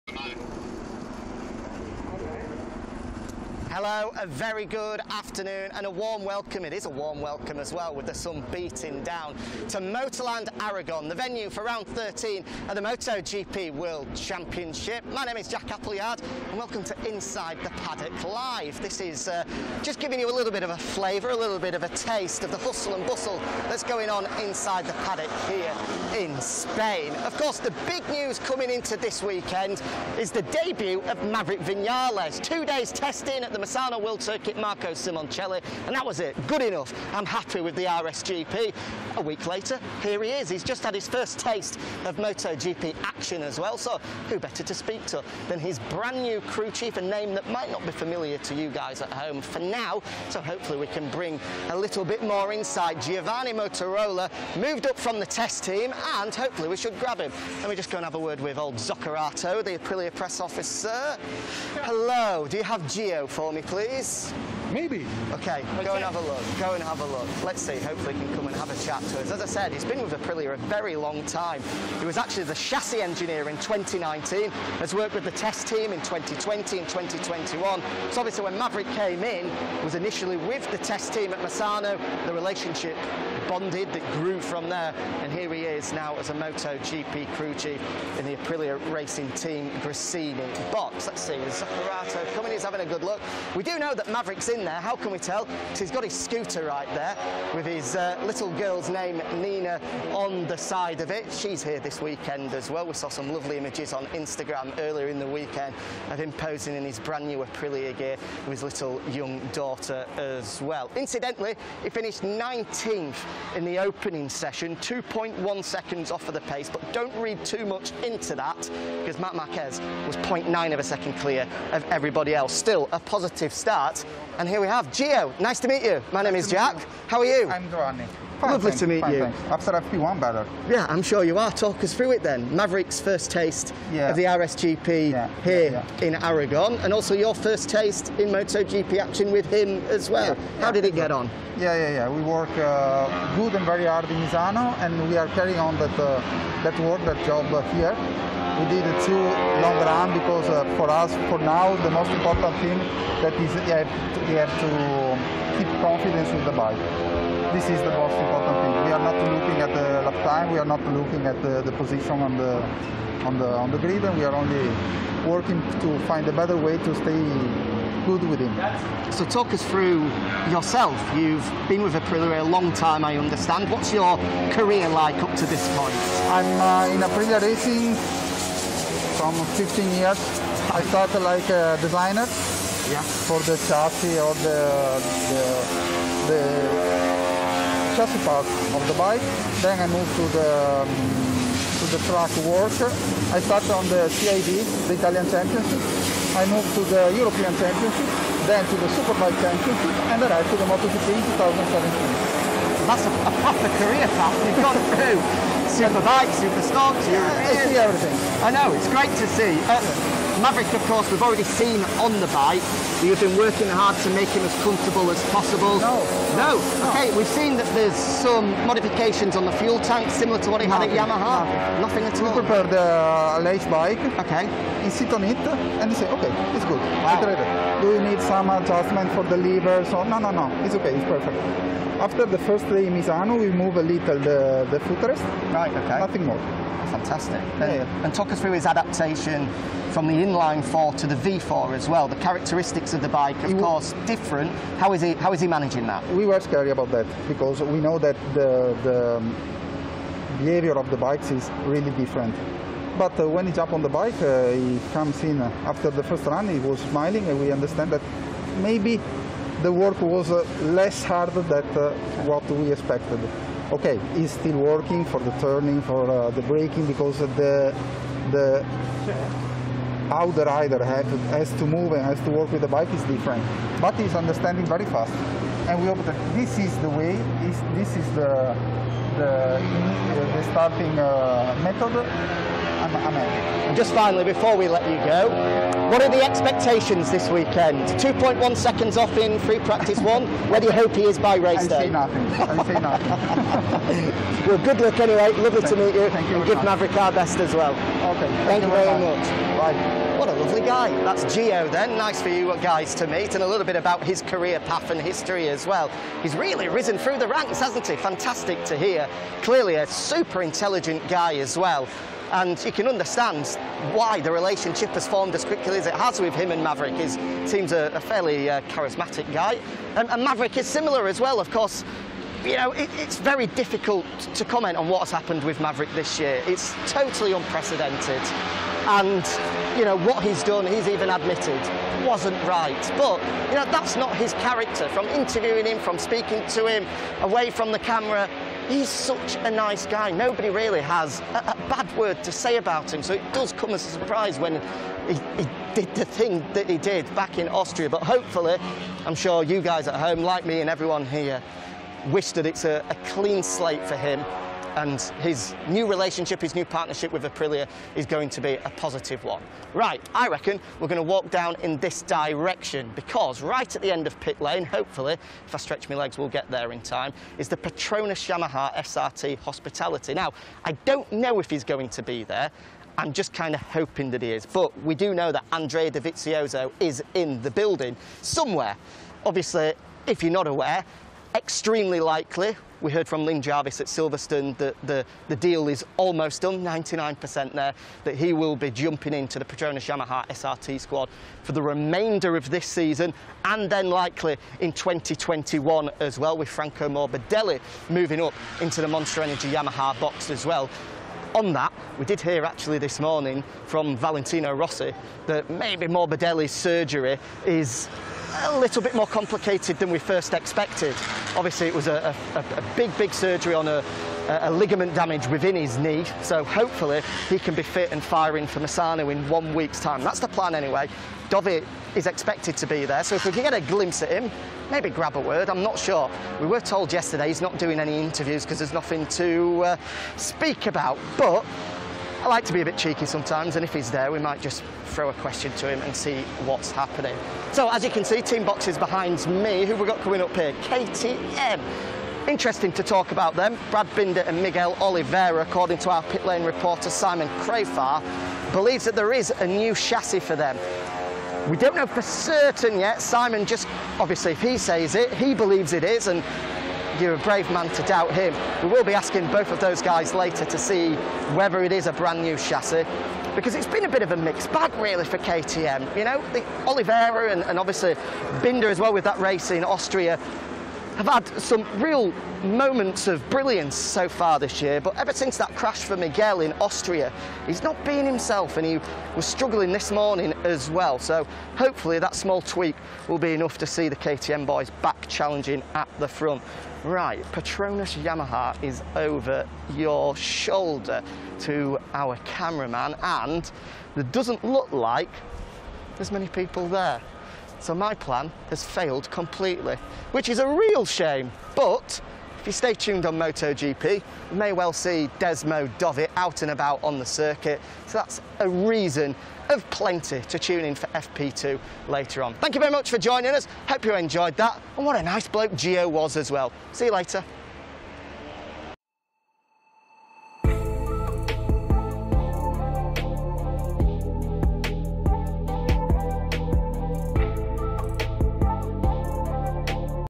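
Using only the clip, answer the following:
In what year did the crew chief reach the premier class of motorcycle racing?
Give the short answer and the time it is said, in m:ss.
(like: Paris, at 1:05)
2017, at 3:21.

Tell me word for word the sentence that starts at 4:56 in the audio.
And give Maverick our best as well.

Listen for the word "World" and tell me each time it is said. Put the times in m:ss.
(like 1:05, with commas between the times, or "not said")
0:13, 0:34.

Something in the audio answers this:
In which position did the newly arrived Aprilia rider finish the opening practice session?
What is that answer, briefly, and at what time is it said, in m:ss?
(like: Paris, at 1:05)
19th, at 1:52.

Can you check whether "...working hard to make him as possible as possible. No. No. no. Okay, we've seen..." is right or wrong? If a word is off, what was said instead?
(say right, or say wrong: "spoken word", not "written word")
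wrong: "comfortable", not "possible".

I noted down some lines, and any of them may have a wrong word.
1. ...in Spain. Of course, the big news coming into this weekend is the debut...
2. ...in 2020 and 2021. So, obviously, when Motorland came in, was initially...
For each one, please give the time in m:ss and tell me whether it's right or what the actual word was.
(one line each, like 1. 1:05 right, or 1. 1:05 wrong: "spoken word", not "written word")
1. 0:26 right
2. 1:15 wrong: "Maverick", not "Motorland".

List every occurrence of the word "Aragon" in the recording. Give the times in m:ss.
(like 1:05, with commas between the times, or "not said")
0:10, 2:16.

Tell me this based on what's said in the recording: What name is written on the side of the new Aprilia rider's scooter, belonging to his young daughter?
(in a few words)
Nina.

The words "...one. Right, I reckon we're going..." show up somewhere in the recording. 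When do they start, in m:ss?
5:59.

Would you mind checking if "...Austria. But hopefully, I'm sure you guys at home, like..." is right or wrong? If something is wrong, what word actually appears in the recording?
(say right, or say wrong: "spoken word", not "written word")
right.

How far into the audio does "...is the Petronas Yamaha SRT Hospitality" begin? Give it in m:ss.
6:07.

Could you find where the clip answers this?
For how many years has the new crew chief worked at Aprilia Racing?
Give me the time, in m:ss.
2:59.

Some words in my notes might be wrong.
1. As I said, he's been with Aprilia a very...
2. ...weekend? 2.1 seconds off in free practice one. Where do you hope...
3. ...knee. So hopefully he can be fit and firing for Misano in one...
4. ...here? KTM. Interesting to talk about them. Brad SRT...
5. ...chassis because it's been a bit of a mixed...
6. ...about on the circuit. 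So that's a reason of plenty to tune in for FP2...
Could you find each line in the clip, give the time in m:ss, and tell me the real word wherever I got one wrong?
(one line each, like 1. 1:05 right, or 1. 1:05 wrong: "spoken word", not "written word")
1. 1:09 right
2. 4:47 right
3. 6:55 right
4. 7:20 wrong: "Binder", not "SRT"
5. 7:42 right
6. 8:26 right.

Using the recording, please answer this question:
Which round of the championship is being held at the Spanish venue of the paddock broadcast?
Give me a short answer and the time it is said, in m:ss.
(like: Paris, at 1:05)
13, at 0:11.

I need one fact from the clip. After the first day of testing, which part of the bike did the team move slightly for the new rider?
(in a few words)
Footrest.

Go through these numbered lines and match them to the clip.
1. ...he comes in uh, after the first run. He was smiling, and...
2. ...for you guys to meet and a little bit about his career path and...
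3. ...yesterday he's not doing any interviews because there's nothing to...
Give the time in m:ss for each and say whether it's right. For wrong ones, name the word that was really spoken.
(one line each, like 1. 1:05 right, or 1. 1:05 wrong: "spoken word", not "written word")
1. 4:14 right
2. 5:02 right
3. 7:06 right.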